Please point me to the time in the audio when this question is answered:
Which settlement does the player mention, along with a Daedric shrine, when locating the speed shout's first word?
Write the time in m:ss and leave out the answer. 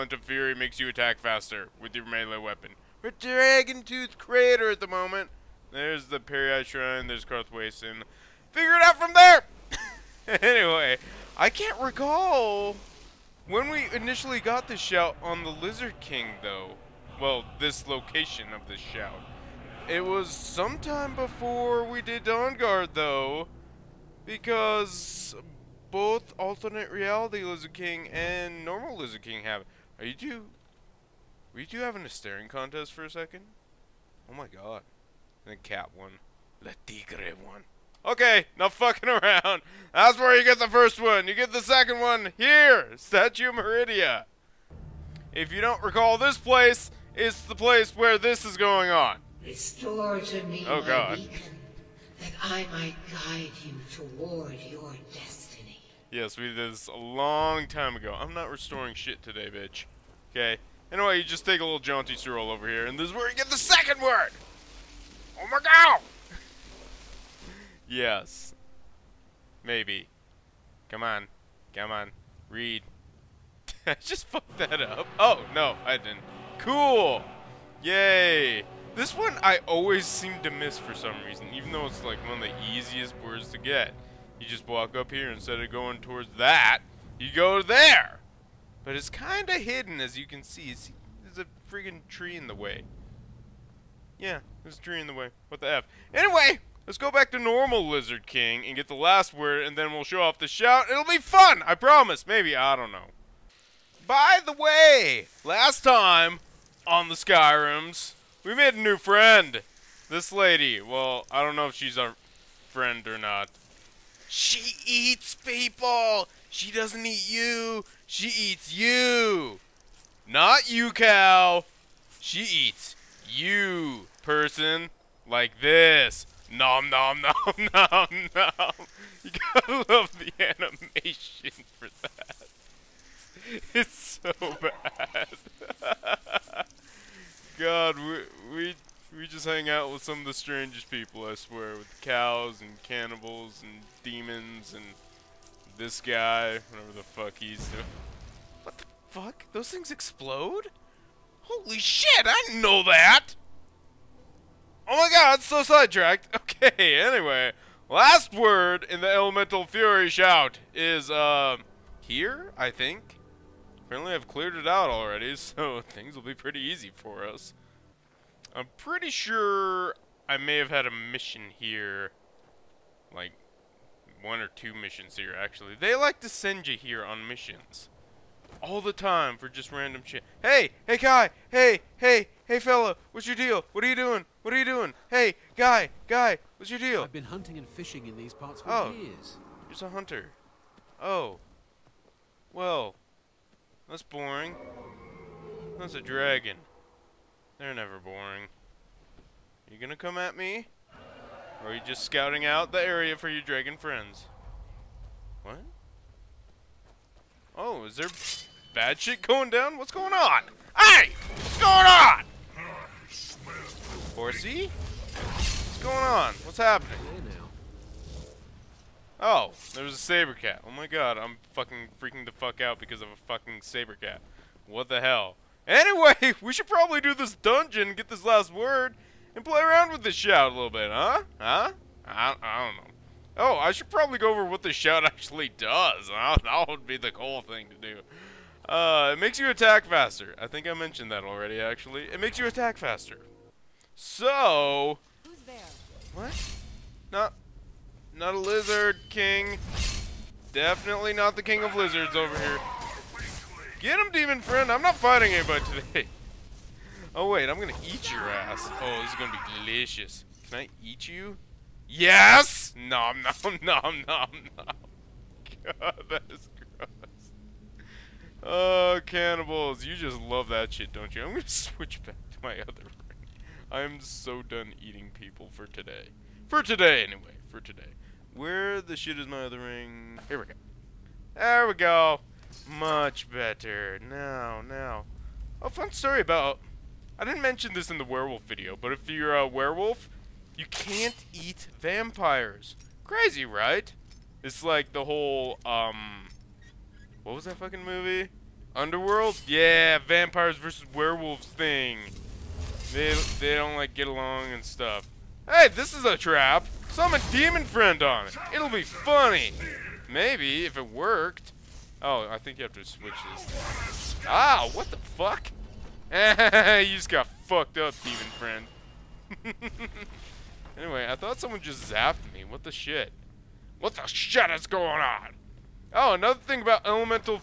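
0:07.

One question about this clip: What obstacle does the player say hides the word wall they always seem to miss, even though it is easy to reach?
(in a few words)
A tree.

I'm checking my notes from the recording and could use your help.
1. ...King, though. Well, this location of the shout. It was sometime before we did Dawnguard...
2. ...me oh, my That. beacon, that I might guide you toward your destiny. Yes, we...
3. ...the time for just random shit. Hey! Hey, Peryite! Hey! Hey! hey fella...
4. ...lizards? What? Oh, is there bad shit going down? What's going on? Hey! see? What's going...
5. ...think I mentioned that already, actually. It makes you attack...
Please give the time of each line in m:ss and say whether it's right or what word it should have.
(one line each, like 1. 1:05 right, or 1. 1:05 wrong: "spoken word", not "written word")
1. 0:16 right
2. 0:50 wrong: "God", not "That"
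3. 2:58 wrong: "Kai", not "Peryite"
4. 3:23 wrong: "friends", not "lizards"
5. 4:00 right.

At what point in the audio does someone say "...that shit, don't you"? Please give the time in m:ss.
4:30.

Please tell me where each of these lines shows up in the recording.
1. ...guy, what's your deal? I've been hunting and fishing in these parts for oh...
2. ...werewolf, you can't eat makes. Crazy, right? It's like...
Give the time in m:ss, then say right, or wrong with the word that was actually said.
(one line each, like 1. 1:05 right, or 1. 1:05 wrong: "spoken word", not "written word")
1. 3:06 right
2. 4:49 wrong: "vampires", not "makes".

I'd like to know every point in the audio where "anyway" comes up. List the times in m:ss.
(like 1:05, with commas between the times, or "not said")
0:10, 1:00, 1:36, 2:36, 3:45, 4:37, 5:20.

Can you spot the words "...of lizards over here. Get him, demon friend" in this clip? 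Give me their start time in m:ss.
4:11.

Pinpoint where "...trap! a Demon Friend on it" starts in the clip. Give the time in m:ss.
5:06.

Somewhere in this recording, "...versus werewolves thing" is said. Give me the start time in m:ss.
5:00.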